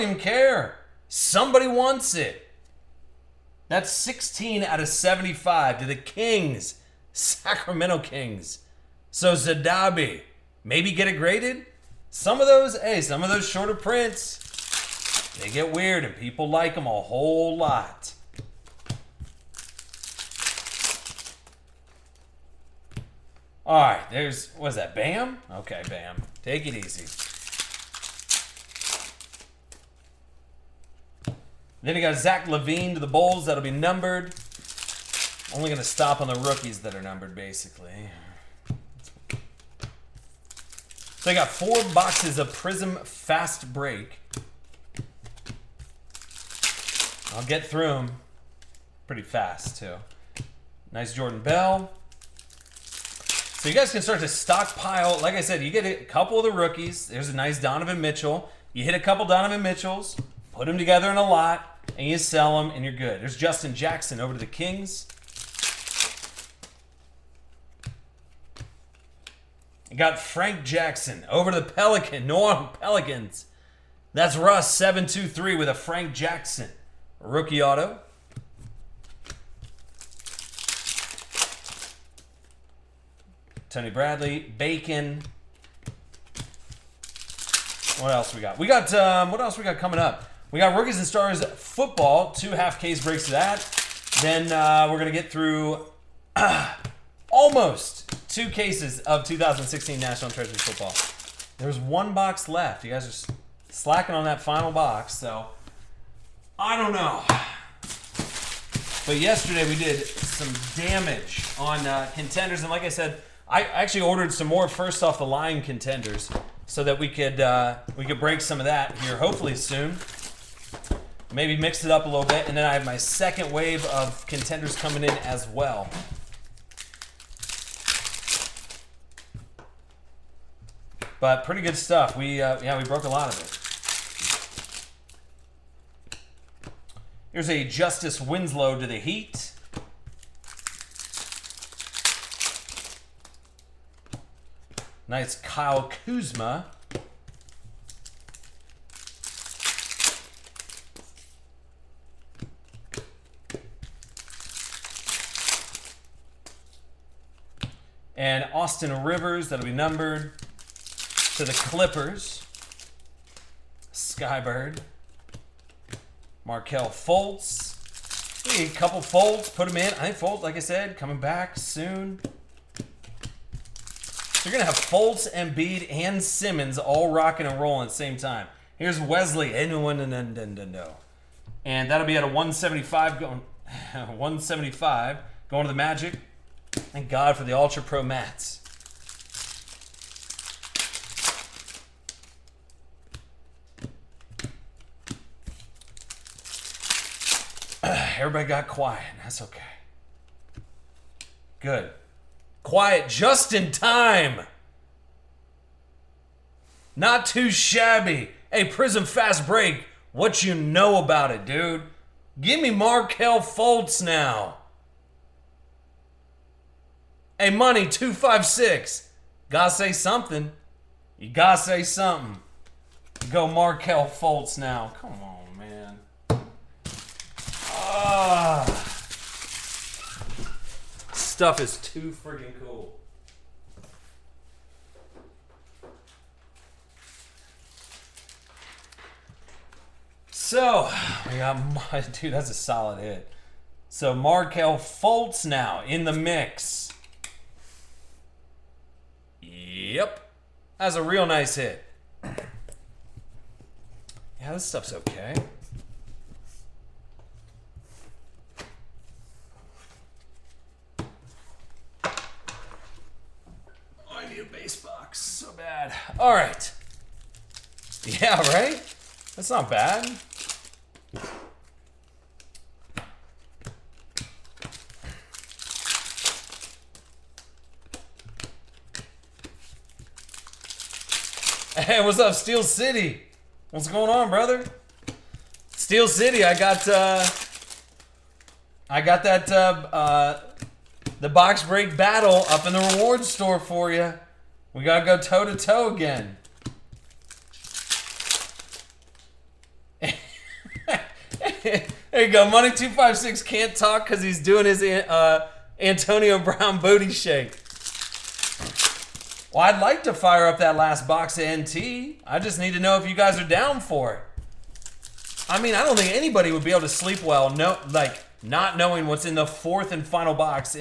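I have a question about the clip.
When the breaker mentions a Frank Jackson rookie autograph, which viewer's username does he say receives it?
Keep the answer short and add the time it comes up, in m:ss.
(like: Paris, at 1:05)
Russ723, at 1:14.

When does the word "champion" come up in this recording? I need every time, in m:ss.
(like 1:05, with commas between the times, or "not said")
not said.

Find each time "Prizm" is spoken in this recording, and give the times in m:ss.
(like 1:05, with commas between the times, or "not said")
0:42, 3:28.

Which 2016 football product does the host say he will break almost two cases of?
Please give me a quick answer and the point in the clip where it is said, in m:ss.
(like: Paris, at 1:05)
National Treasure, at 1:39.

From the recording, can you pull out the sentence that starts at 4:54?
We gotta go toe to toe again.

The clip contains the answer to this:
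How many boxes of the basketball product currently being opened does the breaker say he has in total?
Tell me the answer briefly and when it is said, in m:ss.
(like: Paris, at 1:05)
4, at 0:41.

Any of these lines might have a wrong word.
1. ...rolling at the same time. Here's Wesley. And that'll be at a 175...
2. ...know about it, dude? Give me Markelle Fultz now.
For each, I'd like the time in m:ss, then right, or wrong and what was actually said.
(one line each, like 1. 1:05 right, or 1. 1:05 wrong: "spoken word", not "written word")
1. 2:57 right
2. 3:30 right.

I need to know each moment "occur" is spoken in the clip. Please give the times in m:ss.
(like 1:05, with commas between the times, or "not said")
not said.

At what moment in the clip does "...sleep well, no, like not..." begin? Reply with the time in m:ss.
5:16.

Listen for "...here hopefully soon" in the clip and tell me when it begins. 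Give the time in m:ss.
1:58.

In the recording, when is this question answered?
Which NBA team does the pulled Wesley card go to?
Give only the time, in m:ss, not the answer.
3:05.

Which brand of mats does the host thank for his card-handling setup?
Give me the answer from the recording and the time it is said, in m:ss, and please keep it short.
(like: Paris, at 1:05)
Ultra Pro, at 3:07.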